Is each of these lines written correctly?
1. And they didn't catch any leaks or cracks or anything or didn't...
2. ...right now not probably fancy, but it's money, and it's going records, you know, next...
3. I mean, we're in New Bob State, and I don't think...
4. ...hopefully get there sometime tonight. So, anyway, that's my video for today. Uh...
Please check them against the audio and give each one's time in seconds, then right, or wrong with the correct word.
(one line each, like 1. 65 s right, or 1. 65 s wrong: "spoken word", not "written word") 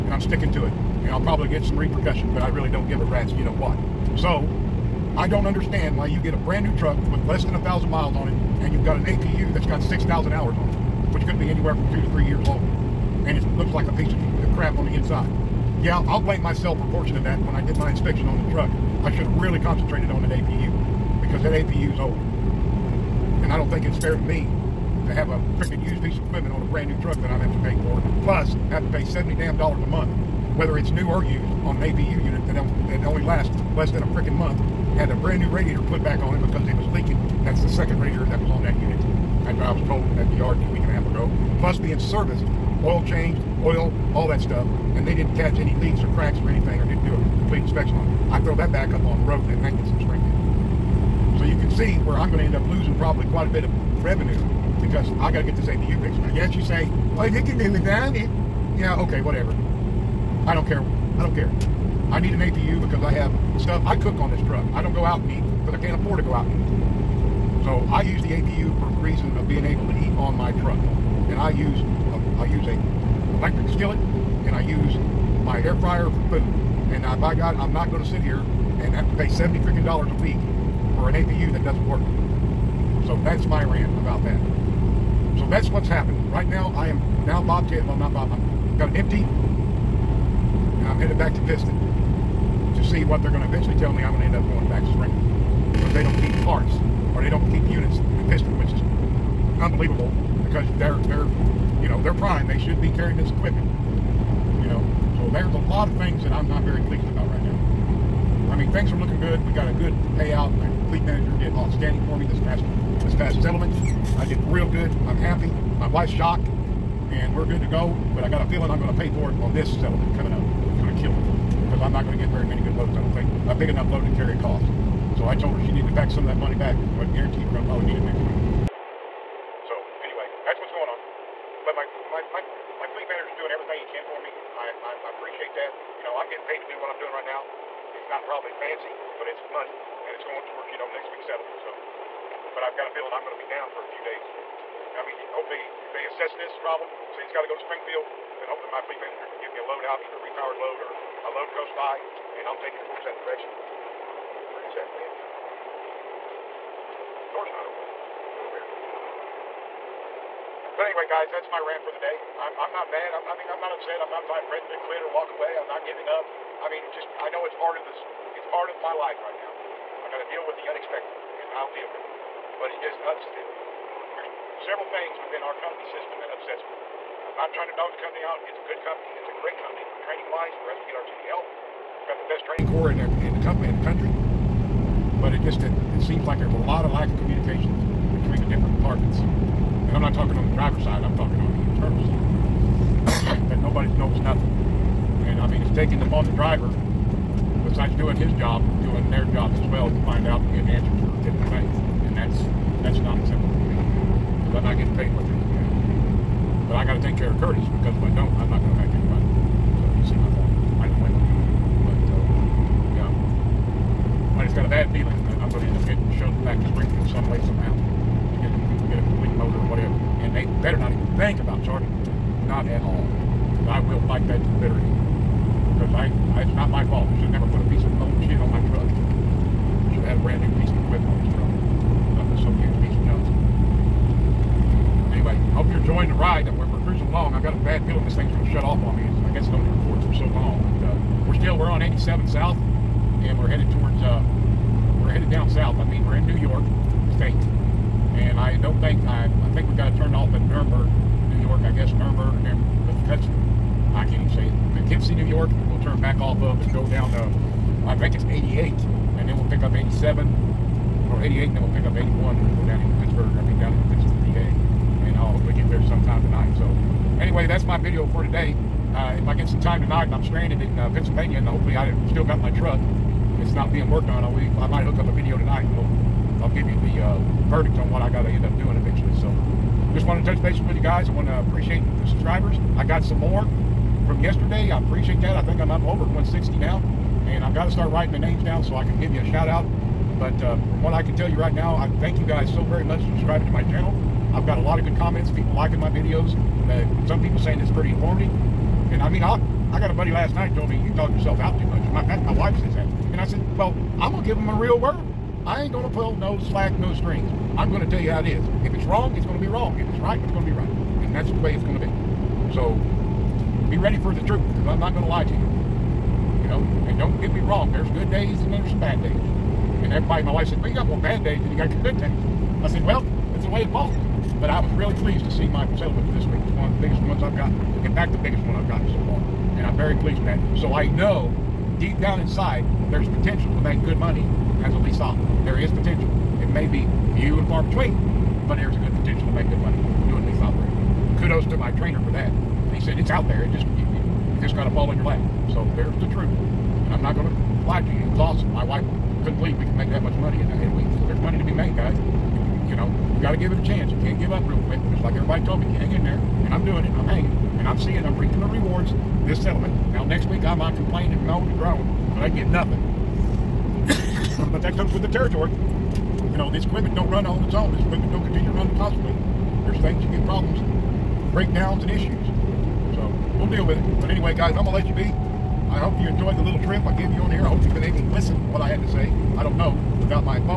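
1. 44 s right
2. 137 s wrong: "towards", not "records"
3. 245 s wrong: "York", not "Bob"
4. 265 s right.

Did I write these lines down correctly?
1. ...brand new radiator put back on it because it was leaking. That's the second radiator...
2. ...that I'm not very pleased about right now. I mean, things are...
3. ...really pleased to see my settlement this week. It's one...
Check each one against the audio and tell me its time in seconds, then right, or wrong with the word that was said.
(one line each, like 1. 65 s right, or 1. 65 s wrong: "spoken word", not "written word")
1. 35 s right
2. 106 s right
3. 324 s right.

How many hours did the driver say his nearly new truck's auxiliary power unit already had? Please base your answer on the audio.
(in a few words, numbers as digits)
6,000.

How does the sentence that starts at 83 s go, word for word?
So that's my rant about that.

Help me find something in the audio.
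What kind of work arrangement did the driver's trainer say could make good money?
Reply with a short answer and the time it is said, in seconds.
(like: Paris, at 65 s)
lease operating, at 340 s.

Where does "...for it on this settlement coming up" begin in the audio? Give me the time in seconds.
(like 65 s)
119 s.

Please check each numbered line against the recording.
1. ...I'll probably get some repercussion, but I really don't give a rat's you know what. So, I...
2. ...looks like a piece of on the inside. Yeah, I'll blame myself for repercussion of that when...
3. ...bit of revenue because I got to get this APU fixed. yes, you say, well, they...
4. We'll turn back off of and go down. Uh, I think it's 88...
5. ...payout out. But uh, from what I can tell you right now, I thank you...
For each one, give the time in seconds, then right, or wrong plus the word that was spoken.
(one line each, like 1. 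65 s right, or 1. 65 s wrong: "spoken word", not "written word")
1. 1 s right
2. 13 s wrong: "portion", not "repercussion"
3. 53 s right
4. 255 s right
5. 289 s wrong: "shout", not "payout".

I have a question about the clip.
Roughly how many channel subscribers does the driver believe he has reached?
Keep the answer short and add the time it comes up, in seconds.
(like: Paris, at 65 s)
160, at 286 s.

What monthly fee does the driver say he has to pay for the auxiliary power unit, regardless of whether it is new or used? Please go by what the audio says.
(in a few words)
$70.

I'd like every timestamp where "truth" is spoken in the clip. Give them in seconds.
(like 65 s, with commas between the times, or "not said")
314 s, 346 s.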